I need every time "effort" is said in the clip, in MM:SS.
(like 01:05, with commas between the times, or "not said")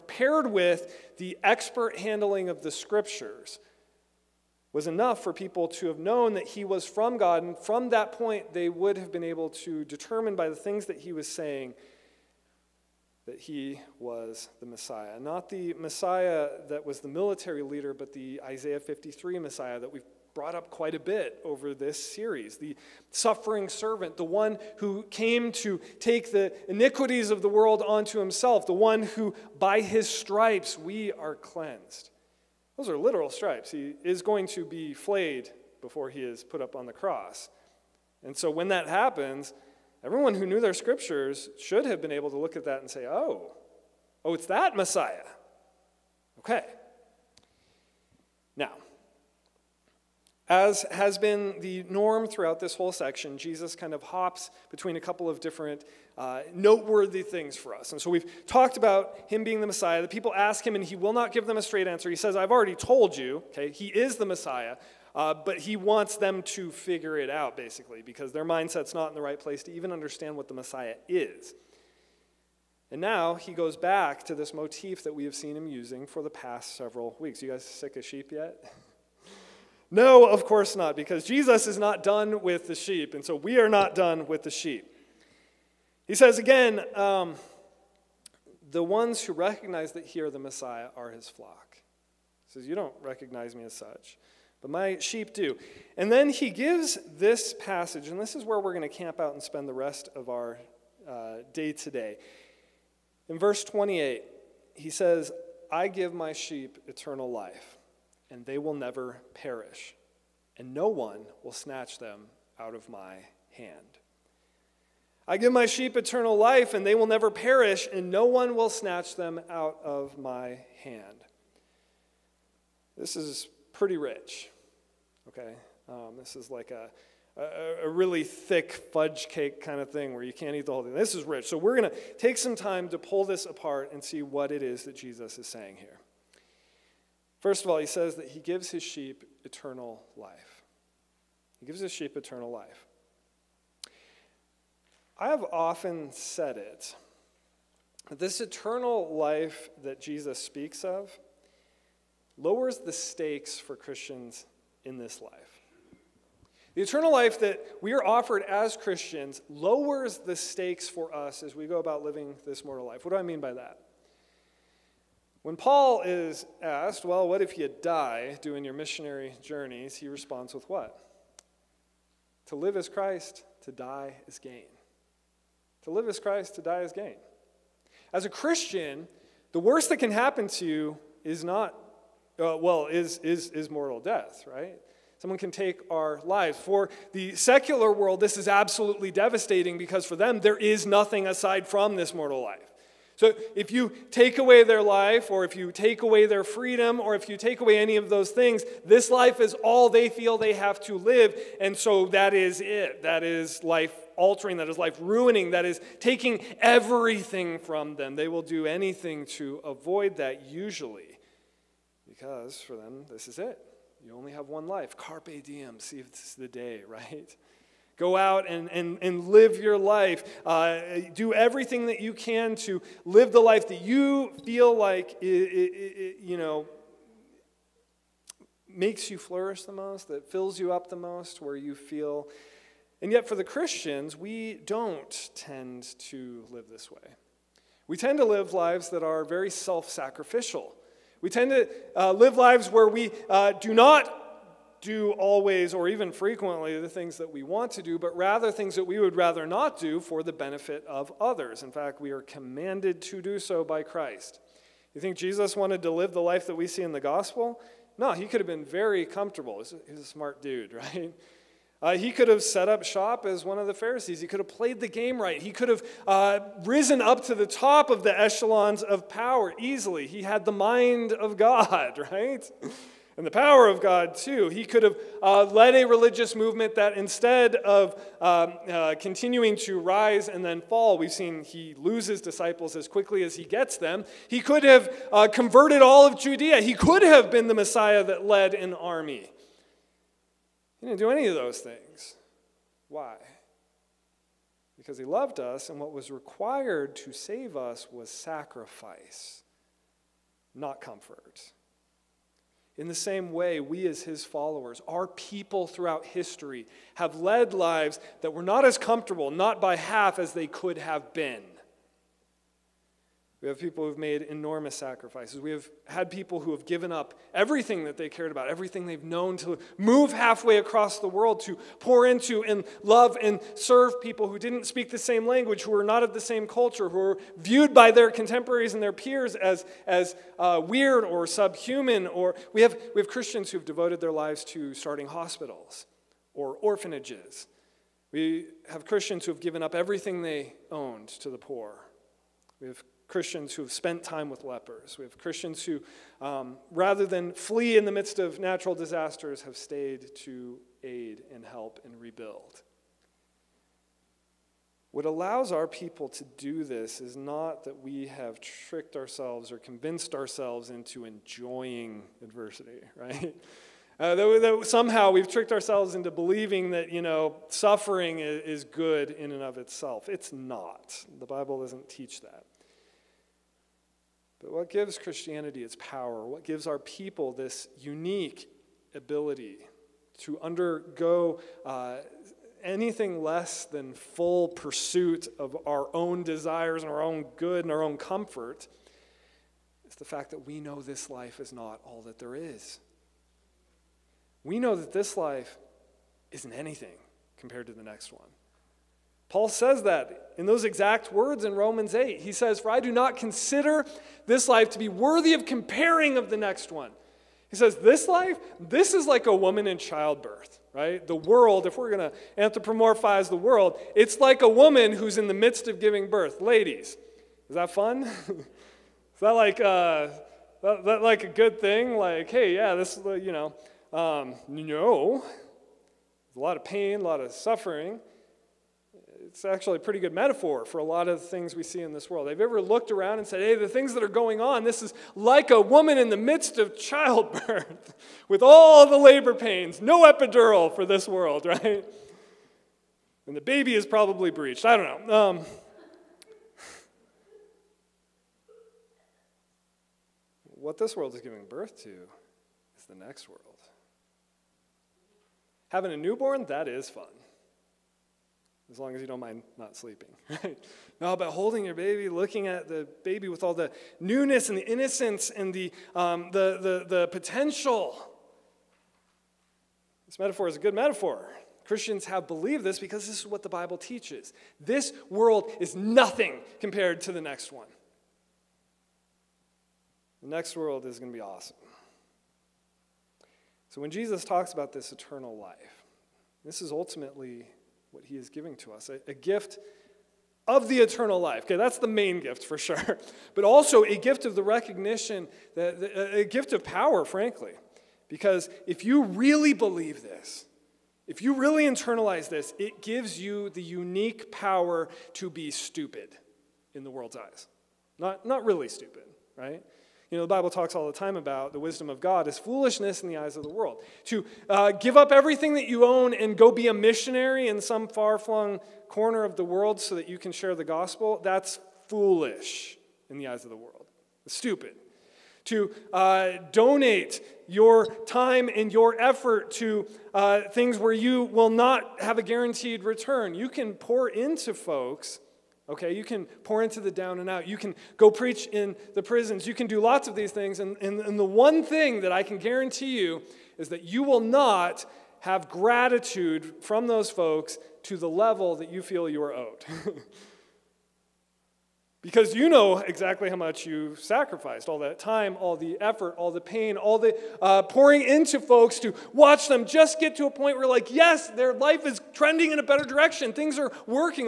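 08:48, 09:15.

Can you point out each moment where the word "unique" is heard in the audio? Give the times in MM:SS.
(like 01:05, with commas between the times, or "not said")
06:17, 08:23.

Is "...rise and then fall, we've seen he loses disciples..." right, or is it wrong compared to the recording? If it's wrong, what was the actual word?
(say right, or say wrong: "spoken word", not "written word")
right.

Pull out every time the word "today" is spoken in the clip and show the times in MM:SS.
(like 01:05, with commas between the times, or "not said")
01:41.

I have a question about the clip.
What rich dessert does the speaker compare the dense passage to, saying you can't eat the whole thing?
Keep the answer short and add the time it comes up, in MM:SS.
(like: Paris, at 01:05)
Fudge cake, at 02:08.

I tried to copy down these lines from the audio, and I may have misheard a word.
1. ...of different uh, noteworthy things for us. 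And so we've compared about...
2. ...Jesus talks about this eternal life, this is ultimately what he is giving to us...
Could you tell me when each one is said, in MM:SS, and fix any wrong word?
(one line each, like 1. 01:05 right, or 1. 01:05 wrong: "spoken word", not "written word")
1. 00:55 wrong: "talked", not "compared"
2. 08:03 right.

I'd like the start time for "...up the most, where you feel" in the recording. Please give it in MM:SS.
03:50.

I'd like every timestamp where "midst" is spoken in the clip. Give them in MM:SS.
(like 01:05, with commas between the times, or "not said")
05:47, 06:55, 07:16.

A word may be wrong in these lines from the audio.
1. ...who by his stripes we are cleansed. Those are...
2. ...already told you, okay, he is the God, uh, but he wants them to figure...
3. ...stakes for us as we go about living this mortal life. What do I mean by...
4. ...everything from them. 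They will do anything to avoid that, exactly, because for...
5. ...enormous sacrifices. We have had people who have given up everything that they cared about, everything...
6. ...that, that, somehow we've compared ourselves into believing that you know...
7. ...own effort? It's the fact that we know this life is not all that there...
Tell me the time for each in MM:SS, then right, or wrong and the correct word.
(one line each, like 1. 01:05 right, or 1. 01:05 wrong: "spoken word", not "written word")
1. 00:29 right
2. 01:02 wrong: "Messiah", not "God"
3. 02:40 right
4. 03:26 wrong: "usually", not "exactly"
5. 05:14 right
6. 06:04 wrong: "tricked", not "compared"
7. 06:27 wrong: "comfort", not "effort".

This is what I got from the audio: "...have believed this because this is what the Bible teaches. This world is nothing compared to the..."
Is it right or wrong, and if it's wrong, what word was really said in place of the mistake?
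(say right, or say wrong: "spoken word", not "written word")
right.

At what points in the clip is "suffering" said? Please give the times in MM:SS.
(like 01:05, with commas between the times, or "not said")
00:23, 06:07, 07:07.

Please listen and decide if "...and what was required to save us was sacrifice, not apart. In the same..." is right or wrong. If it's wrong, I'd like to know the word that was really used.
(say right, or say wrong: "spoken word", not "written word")
wrong: "comfort", not "apart".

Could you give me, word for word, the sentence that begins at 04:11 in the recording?
In fact, we are commanded to do so by Christ.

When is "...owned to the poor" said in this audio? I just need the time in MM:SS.
05:40.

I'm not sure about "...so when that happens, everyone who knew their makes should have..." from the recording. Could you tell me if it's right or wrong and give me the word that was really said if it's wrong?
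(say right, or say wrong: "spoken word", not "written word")
wrong: "scriptures", not "makes".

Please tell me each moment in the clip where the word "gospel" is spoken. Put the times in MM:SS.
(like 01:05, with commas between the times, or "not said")
04:16, 08:40.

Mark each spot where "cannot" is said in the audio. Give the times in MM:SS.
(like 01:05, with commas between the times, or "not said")
not said.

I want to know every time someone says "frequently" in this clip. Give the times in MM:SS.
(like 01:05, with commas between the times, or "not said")
04:06.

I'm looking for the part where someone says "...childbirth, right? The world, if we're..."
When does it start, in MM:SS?
06:49.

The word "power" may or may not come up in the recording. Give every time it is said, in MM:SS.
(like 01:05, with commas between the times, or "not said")
04:29, 04:33, 06:15, 08:16, 08:24.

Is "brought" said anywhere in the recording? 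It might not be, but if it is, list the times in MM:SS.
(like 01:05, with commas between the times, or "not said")
00:20.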